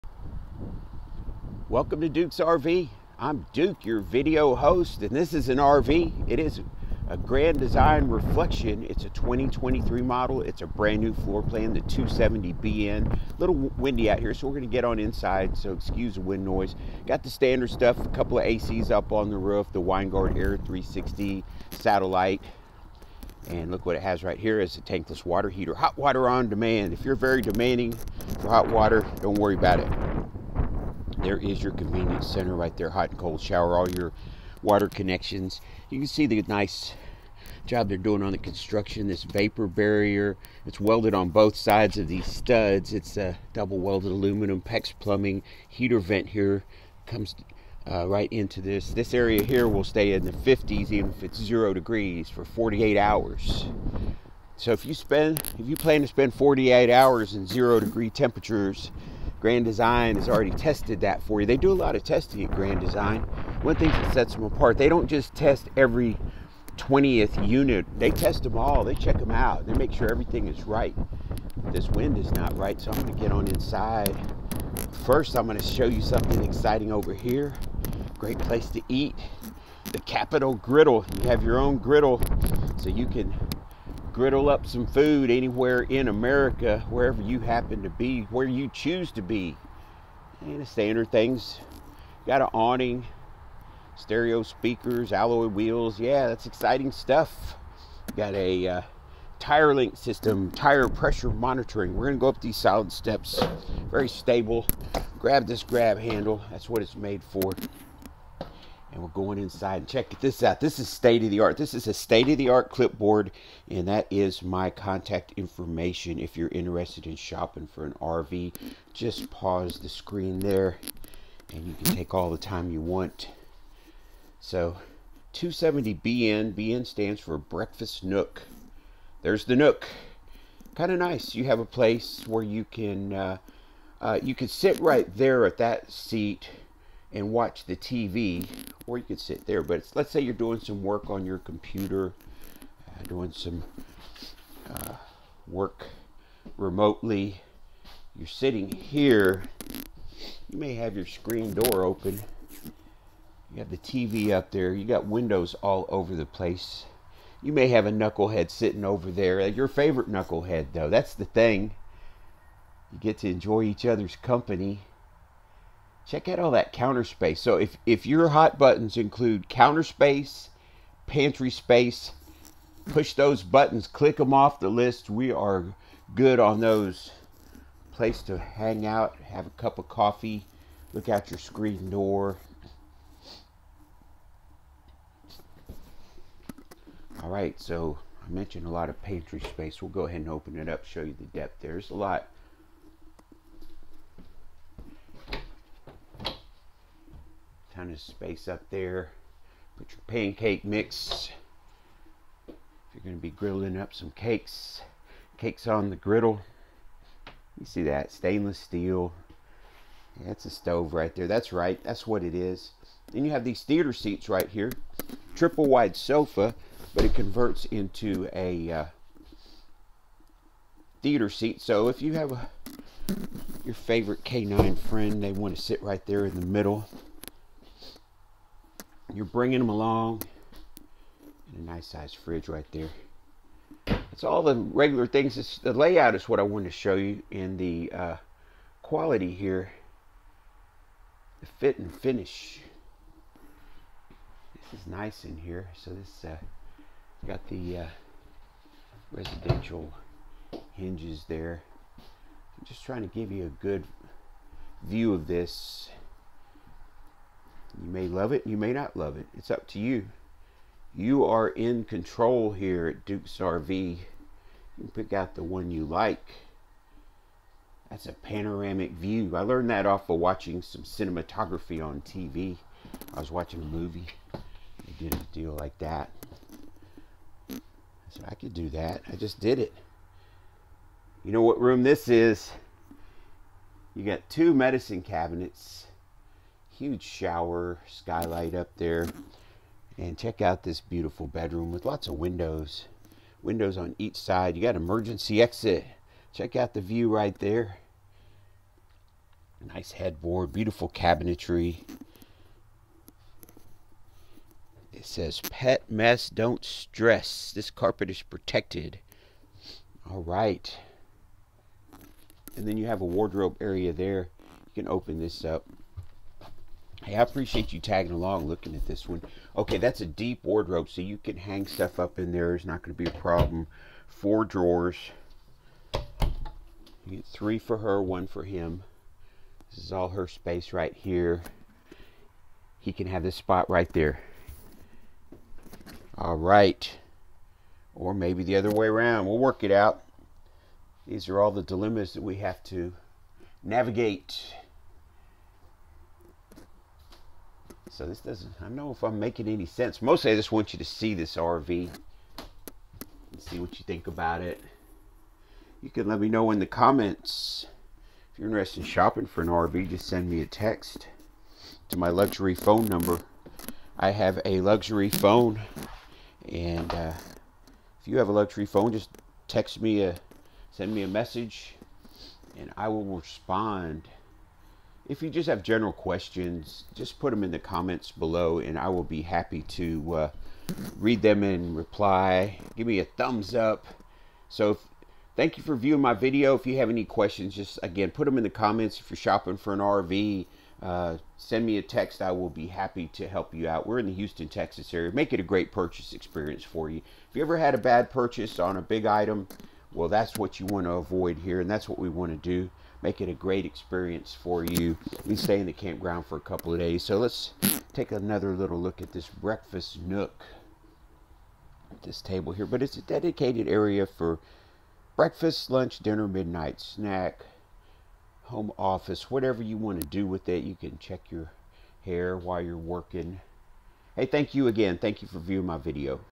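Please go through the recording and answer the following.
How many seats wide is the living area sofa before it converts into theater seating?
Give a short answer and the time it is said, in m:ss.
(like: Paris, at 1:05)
Triple, at 3:35.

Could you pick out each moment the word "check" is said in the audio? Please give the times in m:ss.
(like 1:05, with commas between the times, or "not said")
1:08, 1:49, 2:46, 4:50, 4:56, 7:00.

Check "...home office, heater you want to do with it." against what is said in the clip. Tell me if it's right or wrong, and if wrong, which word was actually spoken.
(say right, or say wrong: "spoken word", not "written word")
wrong: "whatever", not "heater".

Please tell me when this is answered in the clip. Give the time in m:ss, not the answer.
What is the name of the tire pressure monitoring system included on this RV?
1:39.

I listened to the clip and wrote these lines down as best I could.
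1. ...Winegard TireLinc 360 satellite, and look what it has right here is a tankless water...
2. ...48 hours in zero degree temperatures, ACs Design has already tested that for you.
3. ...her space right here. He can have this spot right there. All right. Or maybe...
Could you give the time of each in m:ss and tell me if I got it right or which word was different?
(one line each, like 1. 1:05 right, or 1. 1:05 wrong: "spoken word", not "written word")
1. 0:19 wrong: "Air", not "TireLinc"
2. 0:56 wrong: "Grand", not "ACs"
3. 5:30 right.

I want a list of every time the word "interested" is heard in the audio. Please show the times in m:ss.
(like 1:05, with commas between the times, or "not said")
1:56, 5:58.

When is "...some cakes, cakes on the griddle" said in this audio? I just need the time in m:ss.
3:23.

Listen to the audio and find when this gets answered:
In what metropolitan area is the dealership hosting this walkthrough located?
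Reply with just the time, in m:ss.
6:34.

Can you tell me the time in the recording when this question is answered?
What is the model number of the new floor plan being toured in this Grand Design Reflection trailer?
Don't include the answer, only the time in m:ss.
0:11.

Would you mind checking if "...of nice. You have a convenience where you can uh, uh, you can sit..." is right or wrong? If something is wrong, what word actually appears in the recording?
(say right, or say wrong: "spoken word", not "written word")
wrong: "place", not "convenience".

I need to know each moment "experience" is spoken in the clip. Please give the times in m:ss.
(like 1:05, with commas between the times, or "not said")
6:36, 6:43.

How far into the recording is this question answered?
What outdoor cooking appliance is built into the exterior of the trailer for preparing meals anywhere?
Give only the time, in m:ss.
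1:19.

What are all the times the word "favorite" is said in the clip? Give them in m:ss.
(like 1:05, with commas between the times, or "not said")
2:39, 3:43.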